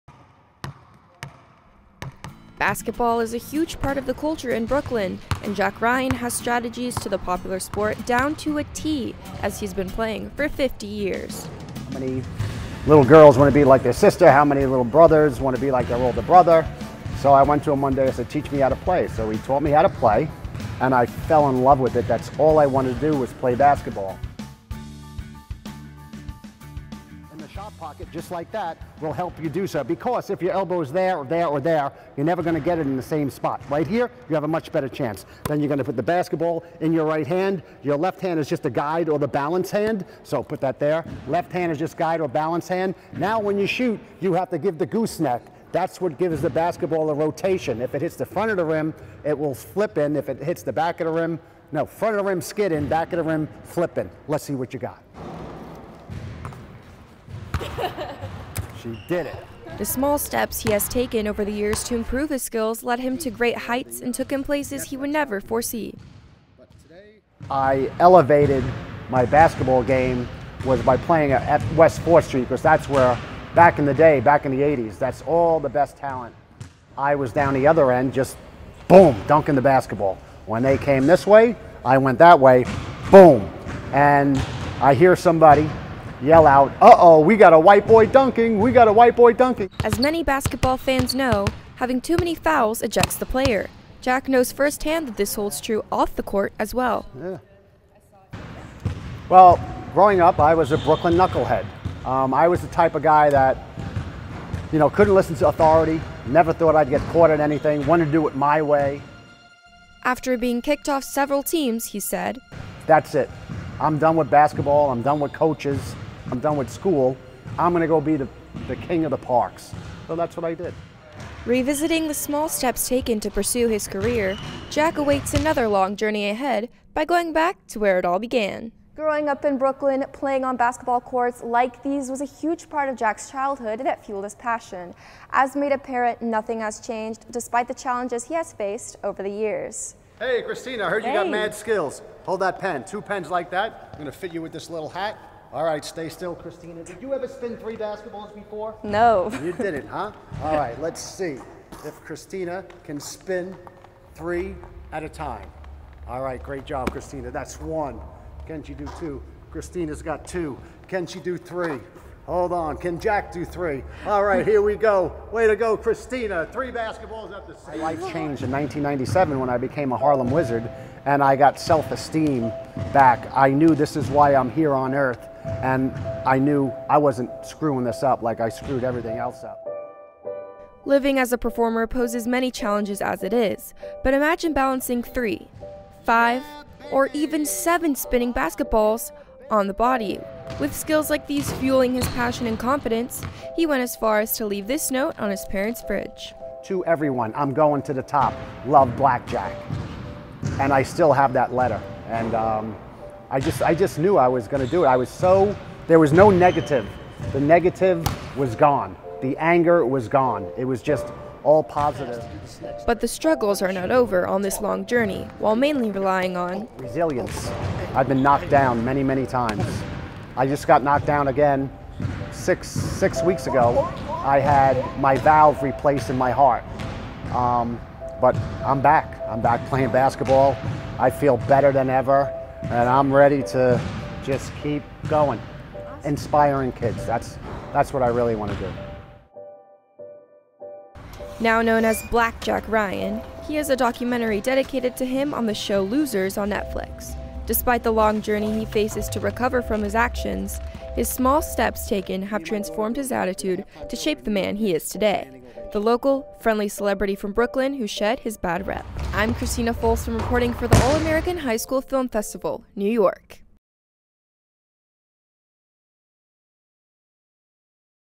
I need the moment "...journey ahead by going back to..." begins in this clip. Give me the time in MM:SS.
02:05.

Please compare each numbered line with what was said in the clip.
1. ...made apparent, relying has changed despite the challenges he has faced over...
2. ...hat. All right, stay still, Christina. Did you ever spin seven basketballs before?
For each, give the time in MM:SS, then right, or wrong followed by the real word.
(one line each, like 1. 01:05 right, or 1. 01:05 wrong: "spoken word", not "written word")
1. 02:15 wrong: "nothing", not "relying"
2. 02:24 wrong: "three", not "seven".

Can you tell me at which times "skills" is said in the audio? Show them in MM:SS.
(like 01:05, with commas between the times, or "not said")
01:02, 02:21, 03:10.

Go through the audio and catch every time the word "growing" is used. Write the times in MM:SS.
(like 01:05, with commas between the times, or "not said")
01:39, 02:08.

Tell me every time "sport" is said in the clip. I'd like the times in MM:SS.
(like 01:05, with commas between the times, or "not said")
00:07.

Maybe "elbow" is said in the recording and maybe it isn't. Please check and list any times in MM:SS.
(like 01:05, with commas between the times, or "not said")
00:30.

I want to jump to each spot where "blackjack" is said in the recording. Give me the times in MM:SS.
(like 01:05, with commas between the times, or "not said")
03:18, 04:02.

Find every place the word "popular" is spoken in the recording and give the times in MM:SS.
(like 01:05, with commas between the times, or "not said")
00:07.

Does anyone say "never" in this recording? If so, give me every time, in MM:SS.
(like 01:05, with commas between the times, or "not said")
00:32, 01:05, 01:46.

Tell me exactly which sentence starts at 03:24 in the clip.
I was so, there was no negative.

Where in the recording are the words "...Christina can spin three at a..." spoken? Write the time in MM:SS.
02:31.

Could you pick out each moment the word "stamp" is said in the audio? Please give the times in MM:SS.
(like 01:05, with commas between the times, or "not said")
not said.